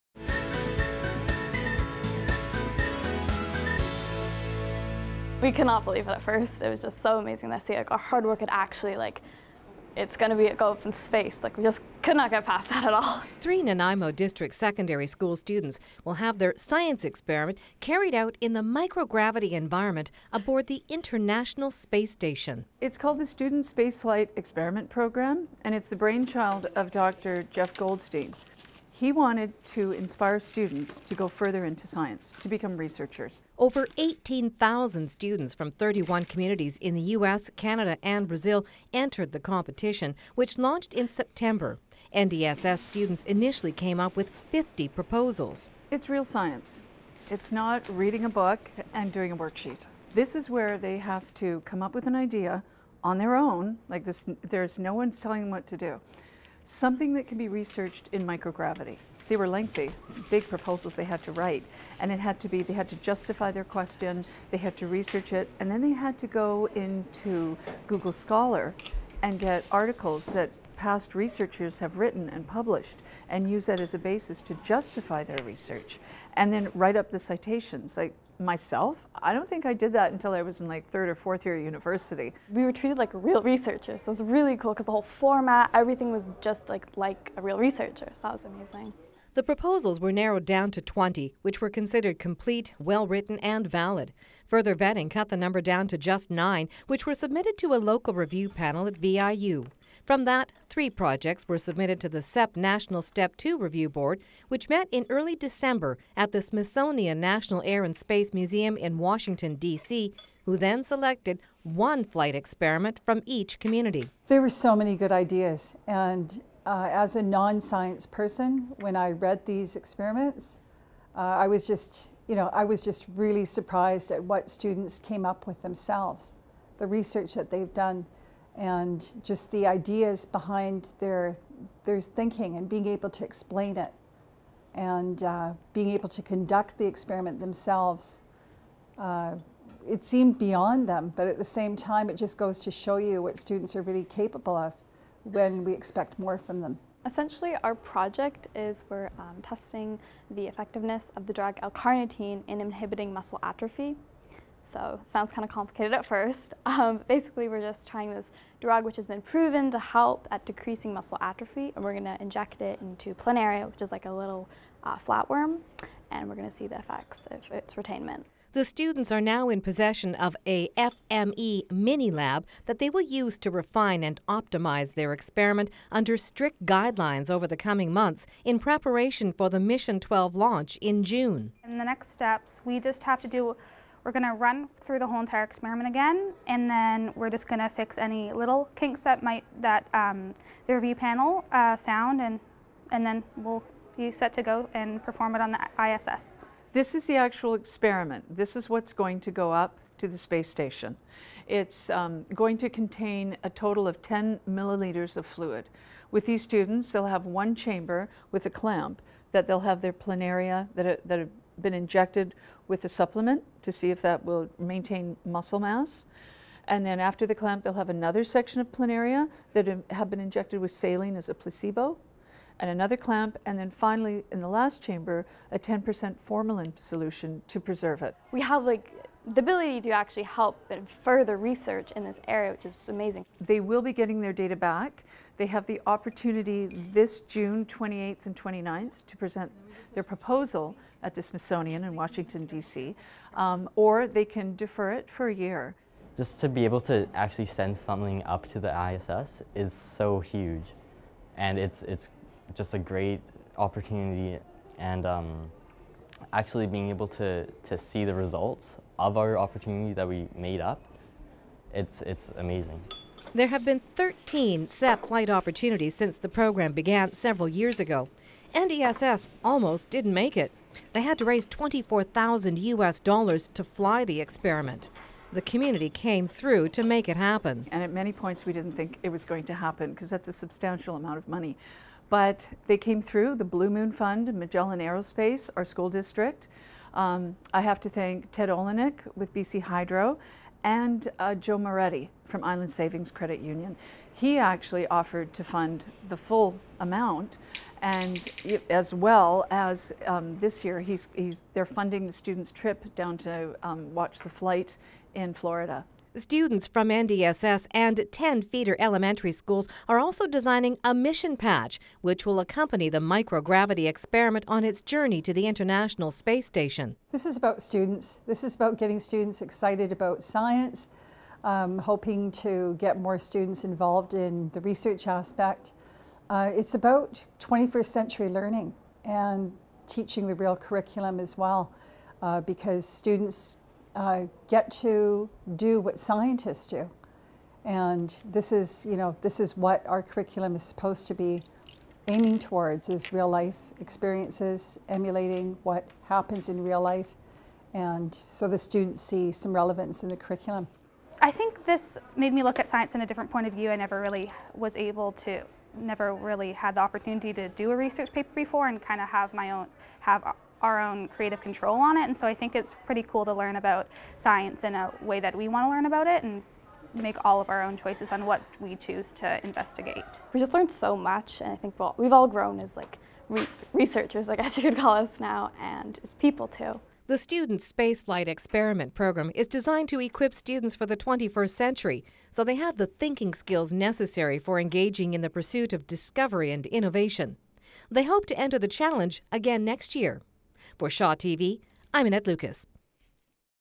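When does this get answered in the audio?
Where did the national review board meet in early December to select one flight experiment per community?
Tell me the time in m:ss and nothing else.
1:46.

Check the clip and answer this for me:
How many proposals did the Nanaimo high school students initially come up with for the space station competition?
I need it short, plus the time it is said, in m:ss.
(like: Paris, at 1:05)
50, at 0:44.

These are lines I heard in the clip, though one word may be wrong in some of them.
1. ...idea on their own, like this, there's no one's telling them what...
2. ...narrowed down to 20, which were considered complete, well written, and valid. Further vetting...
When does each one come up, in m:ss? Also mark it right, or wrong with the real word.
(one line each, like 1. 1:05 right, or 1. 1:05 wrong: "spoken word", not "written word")
1. 0:52 right
2. 1:30 right.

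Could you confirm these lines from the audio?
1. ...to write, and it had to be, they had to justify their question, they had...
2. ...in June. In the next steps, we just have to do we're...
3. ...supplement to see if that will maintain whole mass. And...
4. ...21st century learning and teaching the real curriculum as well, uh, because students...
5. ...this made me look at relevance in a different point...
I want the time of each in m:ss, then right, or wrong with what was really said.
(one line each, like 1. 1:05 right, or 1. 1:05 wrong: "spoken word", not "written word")
1. 1:01 right
2. 3:00 right
3. 3:32 wrong: "muscle", not "whole"
4. 5:27 right
5. 5:51 wrong: "science", not "relevance".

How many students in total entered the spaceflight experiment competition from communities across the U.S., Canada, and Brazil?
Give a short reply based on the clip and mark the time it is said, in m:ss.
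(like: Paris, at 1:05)
18,000, at 0:33.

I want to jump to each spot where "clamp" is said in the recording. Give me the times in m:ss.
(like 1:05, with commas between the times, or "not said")
3:28, 3:37, 3:42.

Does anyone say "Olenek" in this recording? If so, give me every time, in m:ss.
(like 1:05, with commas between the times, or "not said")
4:48.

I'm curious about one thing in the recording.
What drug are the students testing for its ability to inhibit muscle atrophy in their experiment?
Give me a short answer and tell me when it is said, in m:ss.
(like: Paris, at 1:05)
L-carnitine, at 2:31.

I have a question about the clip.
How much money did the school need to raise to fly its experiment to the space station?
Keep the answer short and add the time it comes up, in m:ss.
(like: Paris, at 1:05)
24,000 US dollars, at 4:31.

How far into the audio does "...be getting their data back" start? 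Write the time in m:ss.
3:53.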